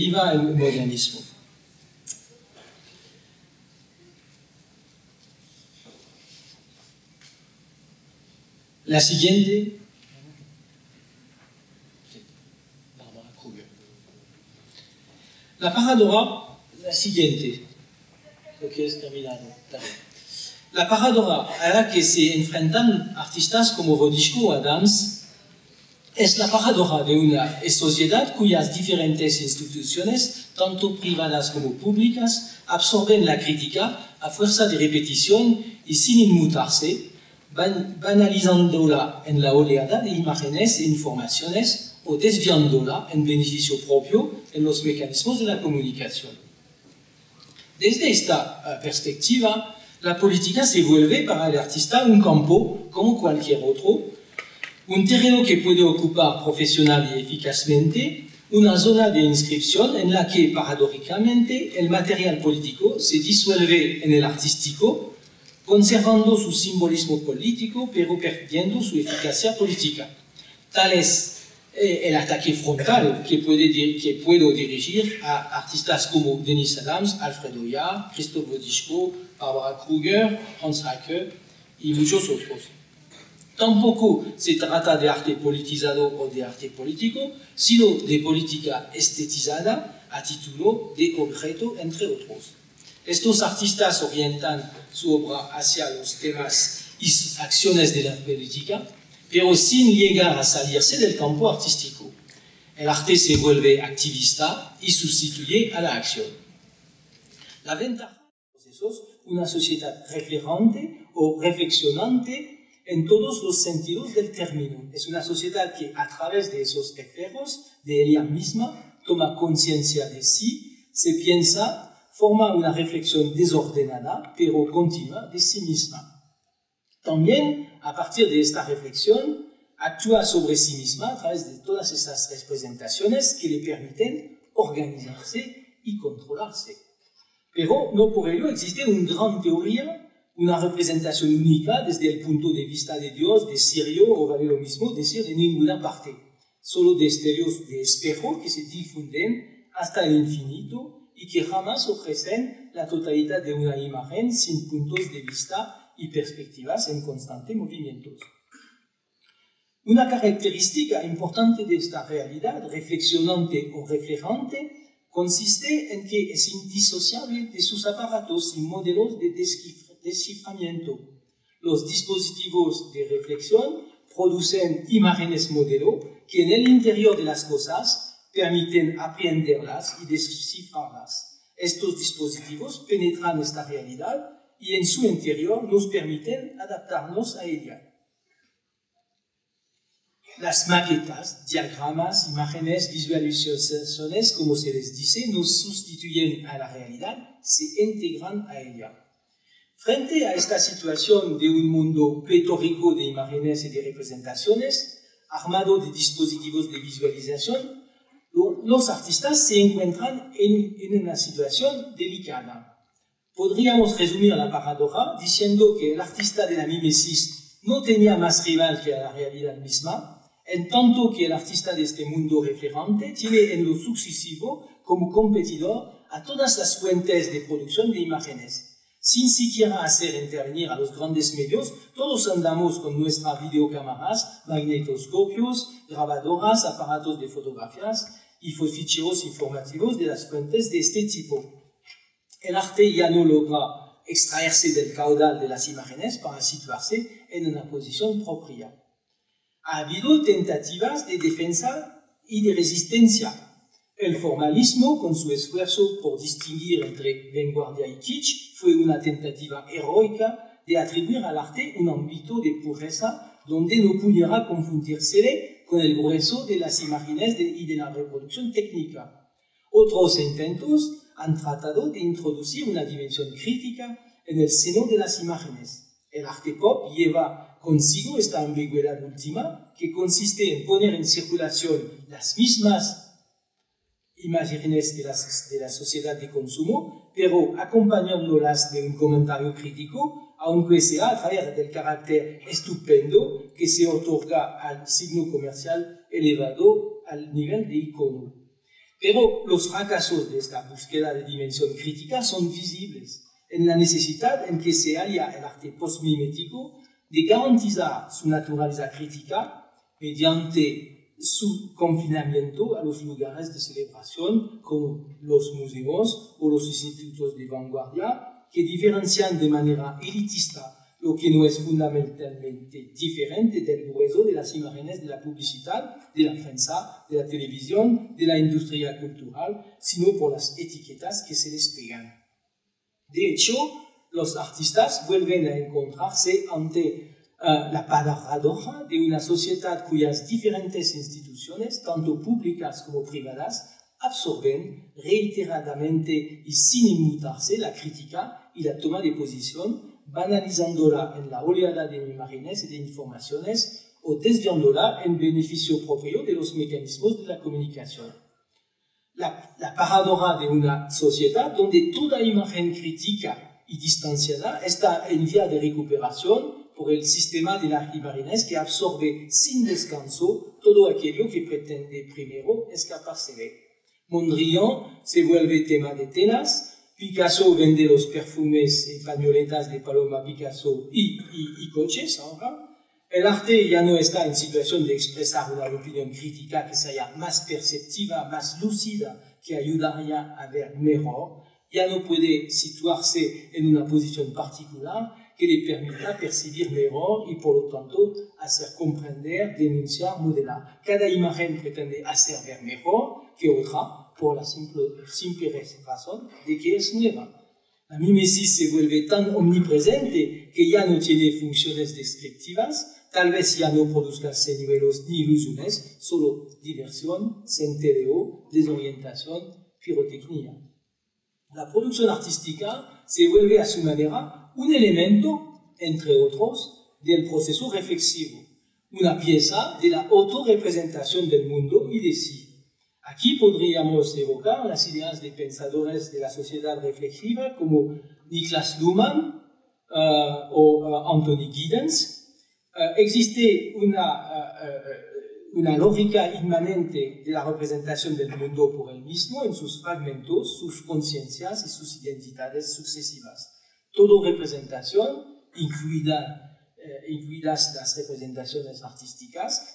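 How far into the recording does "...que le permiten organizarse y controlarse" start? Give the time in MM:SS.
02:13.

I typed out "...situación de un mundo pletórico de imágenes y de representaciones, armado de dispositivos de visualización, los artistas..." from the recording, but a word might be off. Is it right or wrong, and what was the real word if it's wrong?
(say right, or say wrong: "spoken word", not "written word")
right.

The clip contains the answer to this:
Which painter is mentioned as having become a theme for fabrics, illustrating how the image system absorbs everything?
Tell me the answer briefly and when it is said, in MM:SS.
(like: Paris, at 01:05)
Mondrian, at 06:14.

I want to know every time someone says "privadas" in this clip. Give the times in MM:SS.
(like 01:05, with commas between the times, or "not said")
00:30, 05:43.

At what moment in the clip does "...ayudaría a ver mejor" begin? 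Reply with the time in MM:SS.
06:29.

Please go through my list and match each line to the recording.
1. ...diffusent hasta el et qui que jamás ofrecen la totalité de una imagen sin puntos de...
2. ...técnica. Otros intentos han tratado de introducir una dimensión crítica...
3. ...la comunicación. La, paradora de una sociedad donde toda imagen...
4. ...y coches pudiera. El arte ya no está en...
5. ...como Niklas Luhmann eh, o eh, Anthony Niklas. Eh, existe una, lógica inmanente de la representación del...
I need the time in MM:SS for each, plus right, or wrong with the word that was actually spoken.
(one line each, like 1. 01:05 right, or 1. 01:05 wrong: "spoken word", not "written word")
1. 02:28 right
2. 04:28 right
3. 05:57 right
4. 06:21 wrong: "ahora", not "pudiera"
5. 07:17 wrong: "Giddens", not "Niklas".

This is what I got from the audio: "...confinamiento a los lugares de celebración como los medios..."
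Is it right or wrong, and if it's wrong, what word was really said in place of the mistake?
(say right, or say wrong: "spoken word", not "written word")
wrong: "museos", not "medios".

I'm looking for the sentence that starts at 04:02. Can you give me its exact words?
El no logra extraerse del caudal de las imágenes para situarse en una posición propia.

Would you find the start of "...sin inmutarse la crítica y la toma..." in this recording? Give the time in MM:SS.
05:46.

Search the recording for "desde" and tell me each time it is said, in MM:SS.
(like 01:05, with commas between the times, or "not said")
00:47, 02:21.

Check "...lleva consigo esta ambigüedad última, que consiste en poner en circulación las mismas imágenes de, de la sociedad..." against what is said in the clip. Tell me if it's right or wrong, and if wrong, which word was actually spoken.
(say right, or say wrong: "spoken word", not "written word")
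right.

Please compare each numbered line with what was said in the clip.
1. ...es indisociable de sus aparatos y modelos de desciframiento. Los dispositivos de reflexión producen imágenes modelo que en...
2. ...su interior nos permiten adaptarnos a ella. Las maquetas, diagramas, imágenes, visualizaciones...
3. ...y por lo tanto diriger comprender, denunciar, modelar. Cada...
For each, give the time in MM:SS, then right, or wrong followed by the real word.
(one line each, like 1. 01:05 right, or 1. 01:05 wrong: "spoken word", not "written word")
1. 02:46 right
2. 03:04 right
3. 06:37 wrong: "hacer", not "diriger".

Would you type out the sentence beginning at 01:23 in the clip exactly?
Tampoco se trata de arte politizado ou de arte político, sino de política estetizada a título de concreto entre otros.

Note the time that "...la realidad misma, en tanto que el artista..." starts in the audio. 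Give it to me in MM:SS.
03:38.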